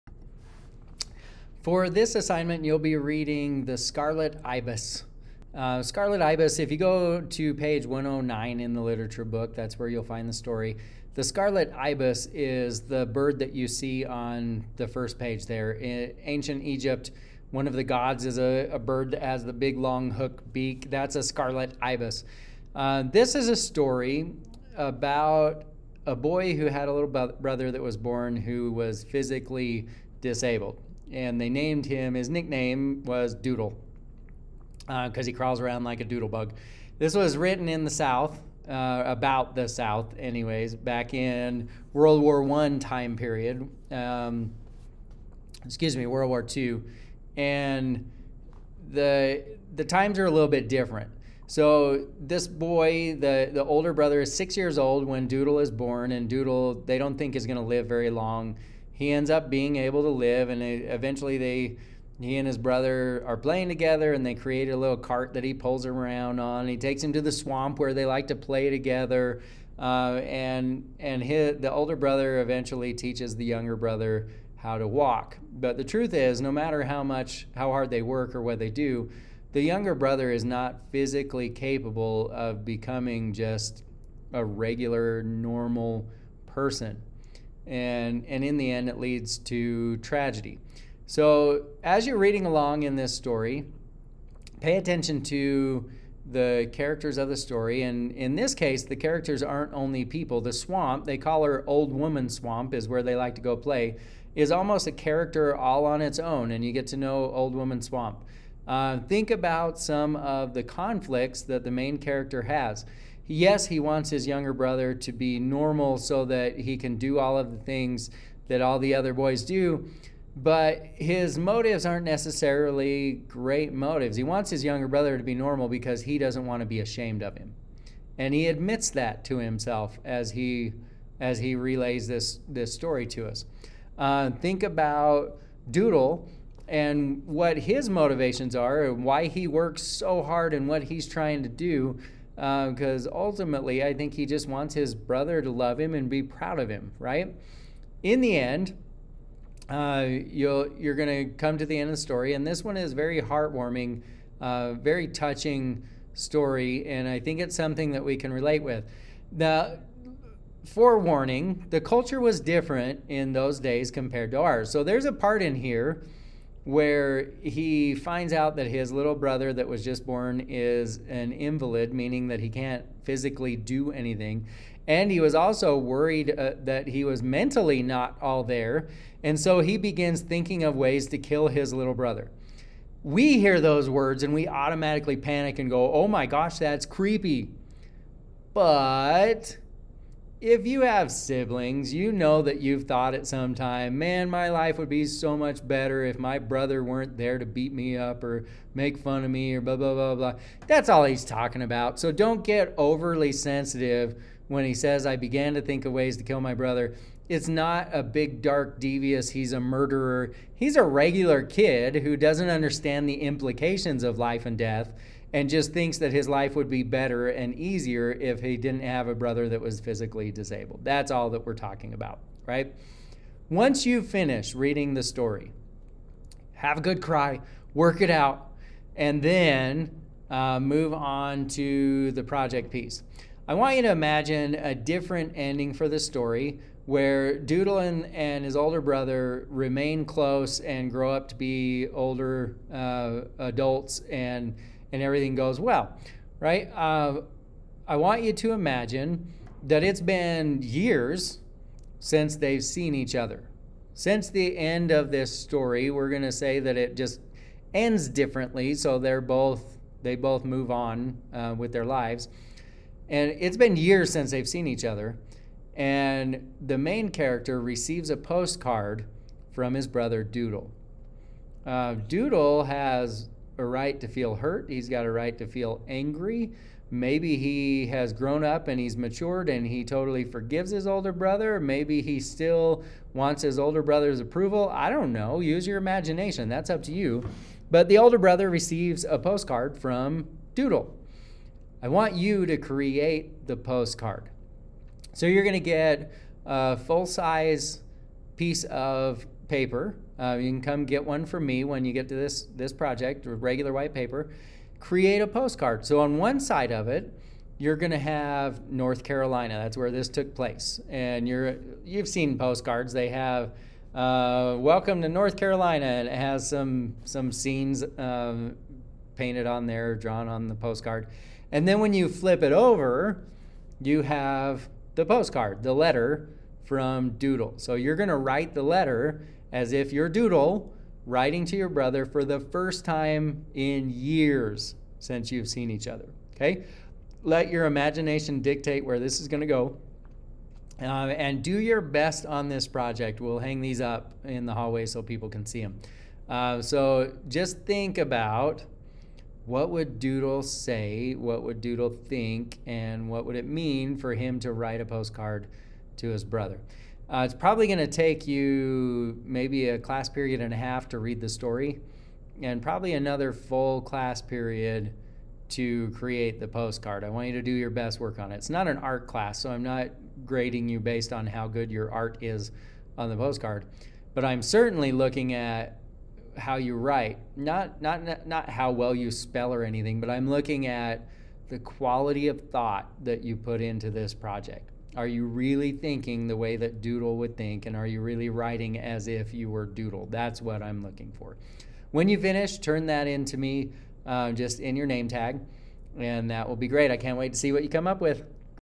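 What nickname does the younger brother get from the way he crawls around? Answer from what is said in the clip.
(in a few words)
Doodlebug.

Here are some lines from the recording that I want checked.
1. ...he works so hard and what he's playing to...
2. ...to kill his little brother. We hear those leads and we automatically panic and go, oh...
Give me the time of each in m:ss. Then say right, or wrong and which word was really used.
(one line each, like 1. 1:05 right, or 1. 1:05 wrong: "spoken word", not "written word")
1. 2:19 wrong: "trying", not "playing"
2. 3:01 wrong: "words", not "leads".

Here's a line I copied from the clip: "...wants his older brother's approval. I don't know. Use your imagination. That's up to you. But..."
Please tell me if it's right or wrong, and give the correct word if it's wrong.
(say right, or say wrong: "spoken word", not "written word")
right.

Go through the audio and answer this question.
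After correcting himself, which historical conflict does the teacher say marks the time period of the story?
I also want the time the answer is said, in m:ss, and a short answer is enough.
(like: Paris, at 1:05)
World War Two, at 0:46.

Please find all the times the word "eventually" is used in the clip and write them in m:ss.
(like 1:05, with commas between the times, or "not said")
1:00, 1:12.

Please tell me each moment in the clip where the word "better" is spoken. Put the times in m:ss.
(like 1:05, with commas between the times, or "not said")
3:15, 3:36.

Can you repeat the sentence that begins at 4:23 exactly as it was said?
And it's been years since they've seen each other.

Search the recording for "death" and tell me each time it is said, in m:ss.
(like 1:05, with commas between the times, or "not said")
3:34.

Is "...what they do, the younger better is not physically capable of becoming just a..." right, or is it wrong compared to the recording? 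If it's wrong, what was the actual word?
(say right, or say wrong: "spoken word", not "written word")
wrong: "brother", not "better".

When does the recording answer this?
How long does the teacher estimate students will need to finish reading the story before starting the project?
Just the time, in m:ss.
5:59.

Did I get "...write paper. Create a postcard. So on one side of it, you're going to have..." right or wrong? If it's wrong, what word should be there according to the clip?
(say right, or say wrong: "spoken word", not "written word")
wrong: "white", not "write".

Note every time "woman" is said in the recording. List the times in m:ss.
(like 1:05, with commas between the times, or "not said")
1:41, 1:47.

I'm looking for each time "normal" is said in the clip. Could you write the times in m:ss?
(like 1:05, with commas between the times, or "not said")
1:25, 1:55, 2:05.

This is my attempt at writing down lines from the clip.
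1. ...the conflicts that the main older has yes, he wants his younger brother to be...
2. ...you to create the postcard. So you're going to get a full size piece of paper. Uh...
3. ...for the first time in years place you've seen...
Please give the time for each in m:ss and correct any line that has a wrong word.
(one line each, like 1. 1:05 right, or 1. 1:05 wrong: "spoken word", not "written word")
1. 1:50 wrong: "character", not "older"
2. 4:52 right
3. 5:32 wrong: "since", not "place".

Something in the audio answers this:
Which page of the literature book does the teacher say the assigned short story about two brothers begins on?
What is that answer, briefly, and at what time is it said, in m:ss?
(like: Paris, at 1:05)
109, at 0:07.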